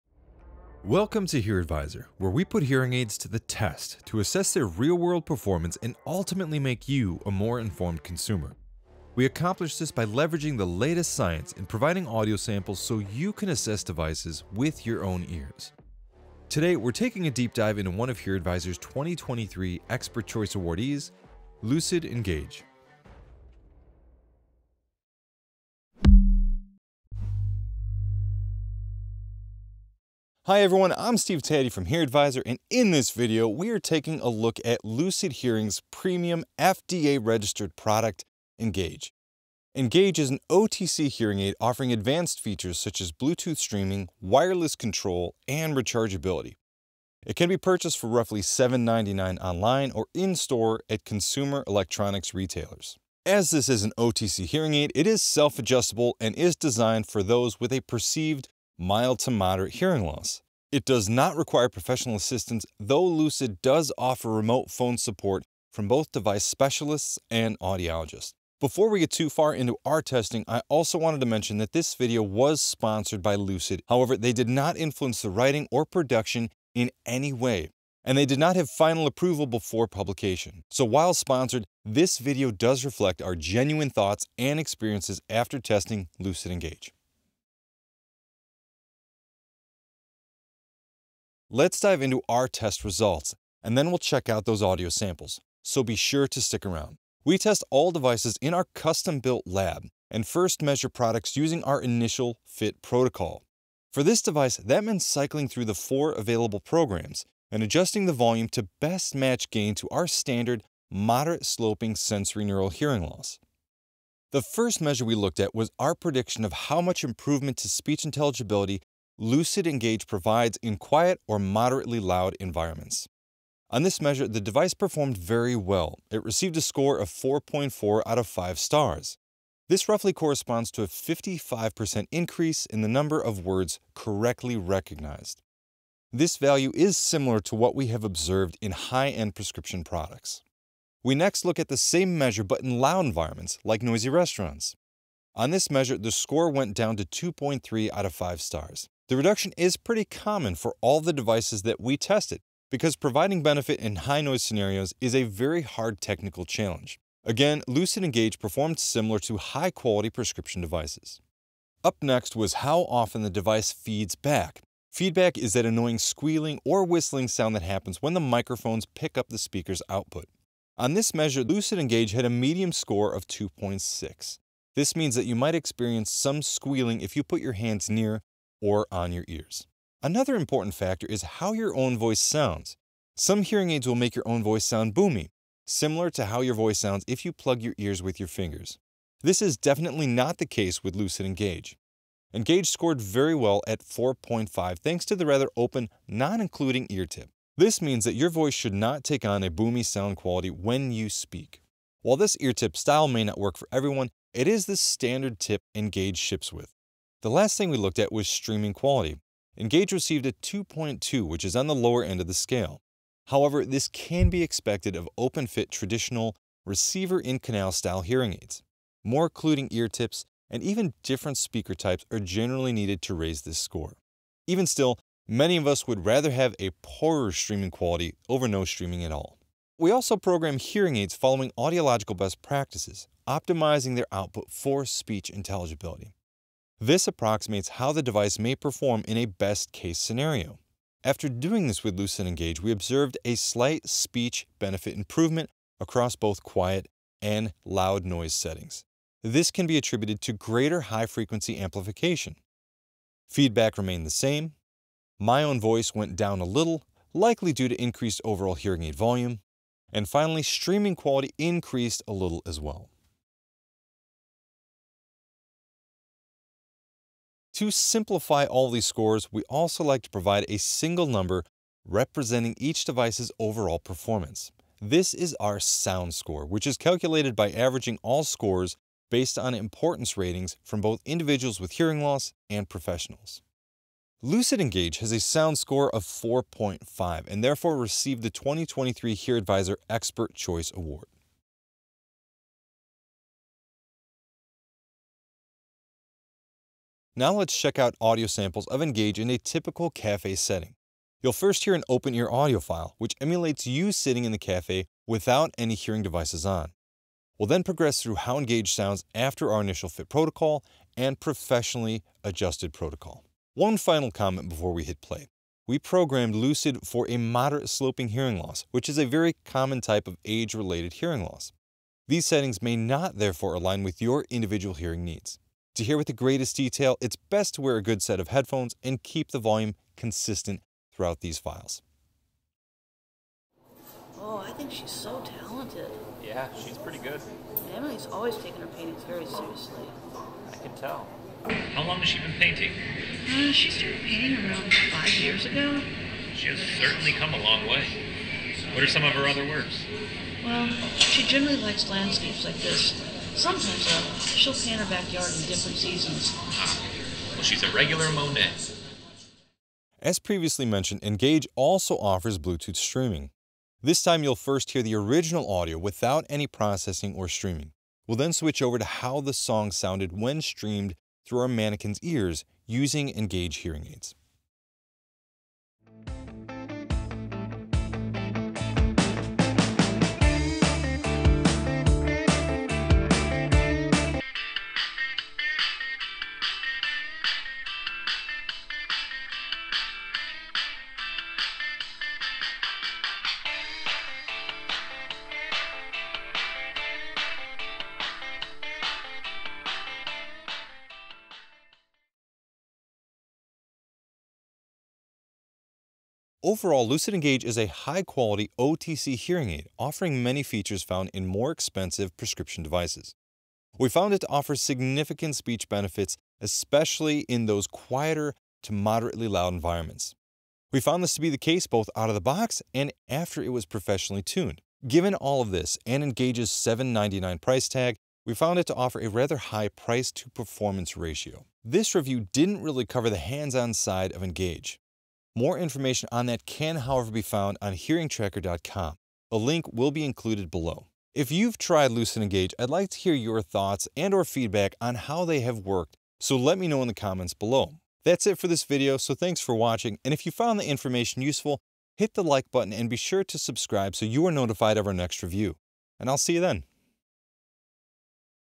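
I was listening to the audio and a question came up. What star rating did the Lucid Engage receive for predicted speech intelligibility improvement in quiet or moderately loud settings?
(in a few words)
4.4.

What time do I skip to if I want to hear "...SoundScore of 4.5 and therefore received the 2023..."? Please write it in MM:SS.
04:45.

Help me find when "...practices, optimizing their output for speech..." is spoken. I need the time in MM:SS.
03:52.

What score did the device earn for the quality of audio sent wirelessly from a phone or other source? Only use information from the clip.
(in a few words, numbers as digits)
2.2.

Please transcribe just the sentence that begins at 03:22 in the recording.
While this ear tip style may not work for everyone, it is the standard tip Engage ships with.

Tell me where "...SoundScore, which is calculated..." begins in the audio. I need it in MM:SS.
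04:35.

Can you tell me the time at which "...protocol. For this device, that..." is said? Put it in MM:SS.
01:42.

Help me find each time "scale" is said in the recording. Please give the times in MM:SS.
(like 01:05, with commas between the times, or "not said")
03:32.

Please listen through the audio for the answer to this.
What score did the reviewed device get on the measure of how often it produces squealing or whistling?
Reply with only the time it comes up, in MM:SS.
02:53.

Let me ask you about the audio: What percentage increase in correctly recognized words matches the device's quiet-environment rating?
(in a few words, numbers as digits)
55%.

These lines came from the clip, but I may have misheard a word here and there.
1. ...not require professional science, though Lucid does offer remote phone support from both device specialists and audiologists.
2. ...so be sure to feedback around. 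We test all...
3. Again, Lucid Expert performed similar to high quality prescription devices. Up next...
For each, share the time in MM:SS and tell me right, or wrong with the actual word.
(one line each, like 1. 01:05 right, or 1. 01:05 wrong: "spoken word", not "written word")
1. 01:01 wrong: "assistance", not "science"
2. 01:35 wrong: "stick", not "feedback"
3. 02:37 wrong: "Engage", not "Expert".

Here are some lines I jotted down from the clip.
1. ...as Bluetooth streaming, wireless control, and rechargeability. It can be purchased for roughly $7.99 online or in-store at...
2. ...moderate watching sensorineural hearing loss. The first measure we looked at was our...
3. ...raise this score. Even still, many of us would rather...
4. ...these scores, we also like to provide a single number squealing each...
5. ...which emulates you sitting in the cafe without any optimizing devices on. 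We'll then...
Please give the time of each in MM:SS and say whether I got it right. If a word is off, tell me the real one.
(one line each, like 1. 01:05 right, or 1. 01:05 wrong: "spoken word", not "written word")
1. 00:42 right
2. 01:50 wrong: "sloping", not "watching"
3. 03:43 right
4. 04:28 wrong: "representing", not "squealing"
5. 05:02 wrong: "hearing", not "optimizing".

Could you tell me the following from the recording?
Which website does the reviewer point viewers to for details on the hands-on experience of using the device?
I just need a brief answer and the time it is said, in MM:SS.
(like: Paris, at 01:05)
hearingtracker.com, at 07:17.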